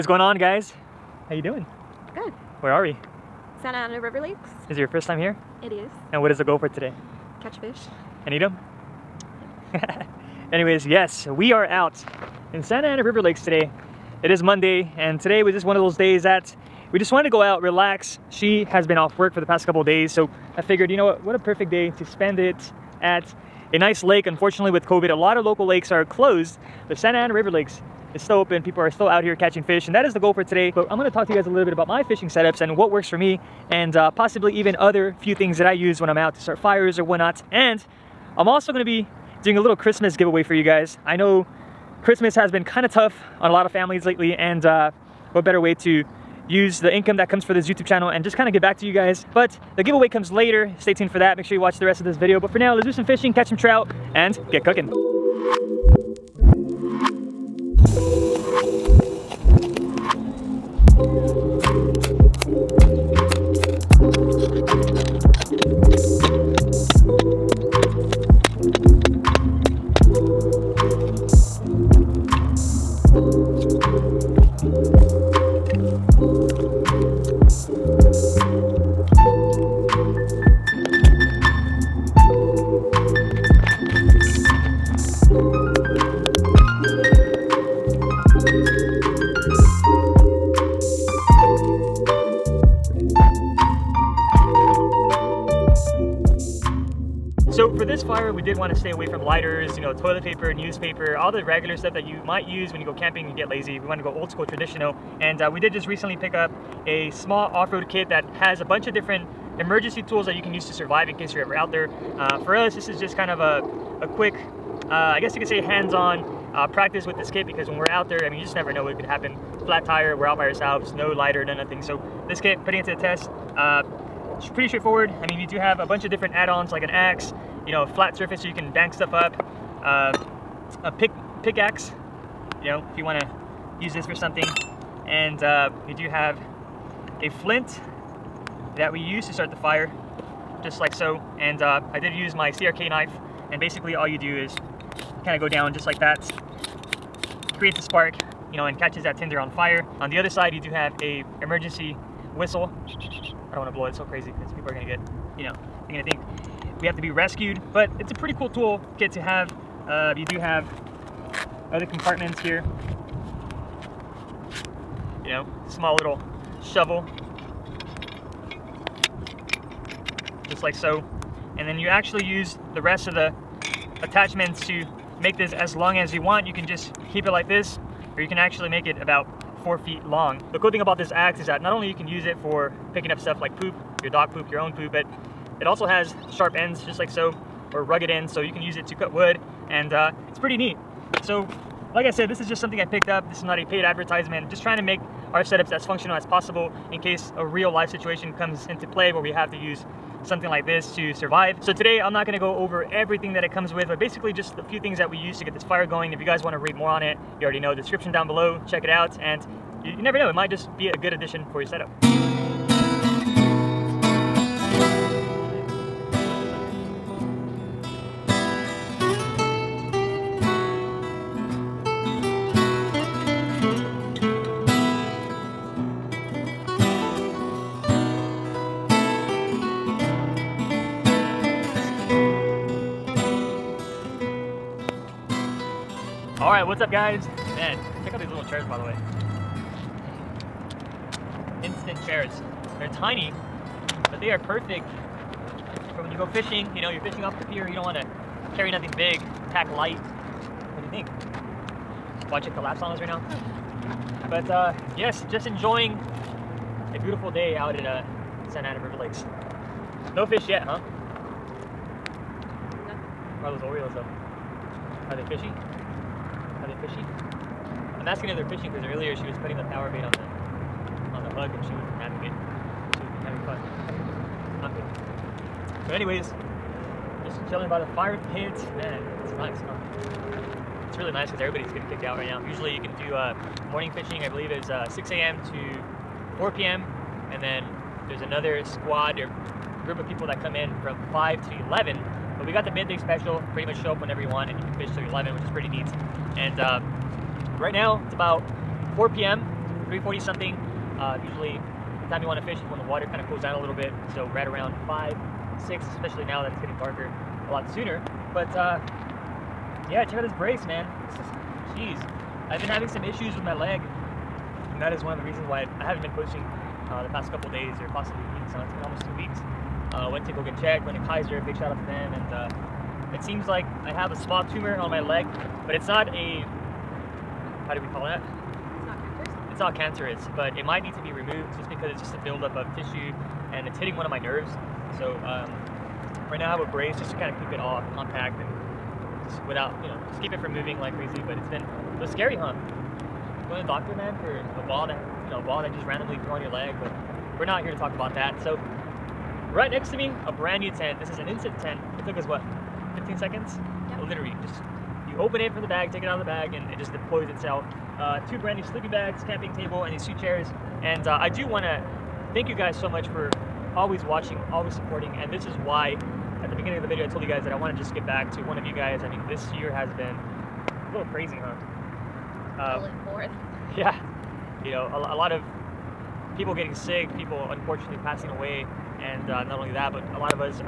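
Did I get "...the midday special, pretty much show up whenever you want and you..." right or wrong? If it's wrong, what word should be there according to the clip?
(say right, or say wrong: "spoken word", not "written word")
right.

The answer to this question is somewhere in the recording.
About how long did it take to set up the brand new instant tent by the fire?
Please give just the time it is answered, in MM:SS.
05:52.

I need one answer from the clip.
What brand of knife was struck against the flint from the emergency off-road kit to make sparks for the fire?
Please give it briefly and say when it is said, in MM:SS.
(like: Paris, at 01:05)
CRK, at 02:22.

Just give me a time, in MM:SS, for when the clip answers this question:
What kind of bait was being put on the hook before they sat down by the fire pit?
04:29.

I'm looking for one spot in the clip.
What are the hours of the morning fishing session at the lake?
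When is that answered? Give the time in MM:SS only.
04:44.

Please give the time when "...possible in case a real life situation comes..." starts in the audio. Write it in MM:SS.
03:16.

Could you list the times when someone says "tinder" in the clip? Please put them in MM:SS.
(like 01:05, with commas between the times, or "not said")
02:29.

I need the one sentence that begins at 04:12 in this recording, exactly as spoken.
Watch it collapse on us right now.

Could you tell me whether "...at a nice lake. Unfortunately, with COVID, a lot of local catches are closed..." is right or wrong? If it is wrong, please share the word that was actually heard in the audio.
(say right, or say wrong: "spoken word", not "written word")
wrong: "lakes", not "catches".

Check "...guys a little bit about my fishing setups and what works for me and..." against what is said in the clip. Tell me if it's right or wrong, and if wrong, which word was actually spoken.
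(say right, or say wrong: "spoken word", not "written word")
right.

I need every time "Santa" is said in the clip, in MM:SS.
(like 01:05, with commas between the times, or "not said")
00:03, 00:12, 00:26, 04:18.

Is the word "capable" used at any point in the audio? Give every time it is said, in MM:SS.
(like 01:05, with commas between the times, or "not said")
not said.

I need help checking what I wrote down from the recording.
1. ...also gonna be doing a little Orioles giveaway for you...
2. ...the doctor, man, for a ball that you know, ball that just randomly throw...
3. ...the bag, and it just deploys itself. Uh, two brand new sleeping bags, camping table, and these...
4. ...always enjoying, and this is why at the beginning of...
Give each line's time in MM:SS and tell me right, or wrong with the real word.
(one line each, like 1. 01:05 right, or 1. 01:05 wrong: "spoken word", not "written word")
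1. 00:38 wrong: "Christmas", not "Orioles"
2. 05:43 right
3. 05:56 right
4. 06:04 wrong: "supporting", not "enjoying".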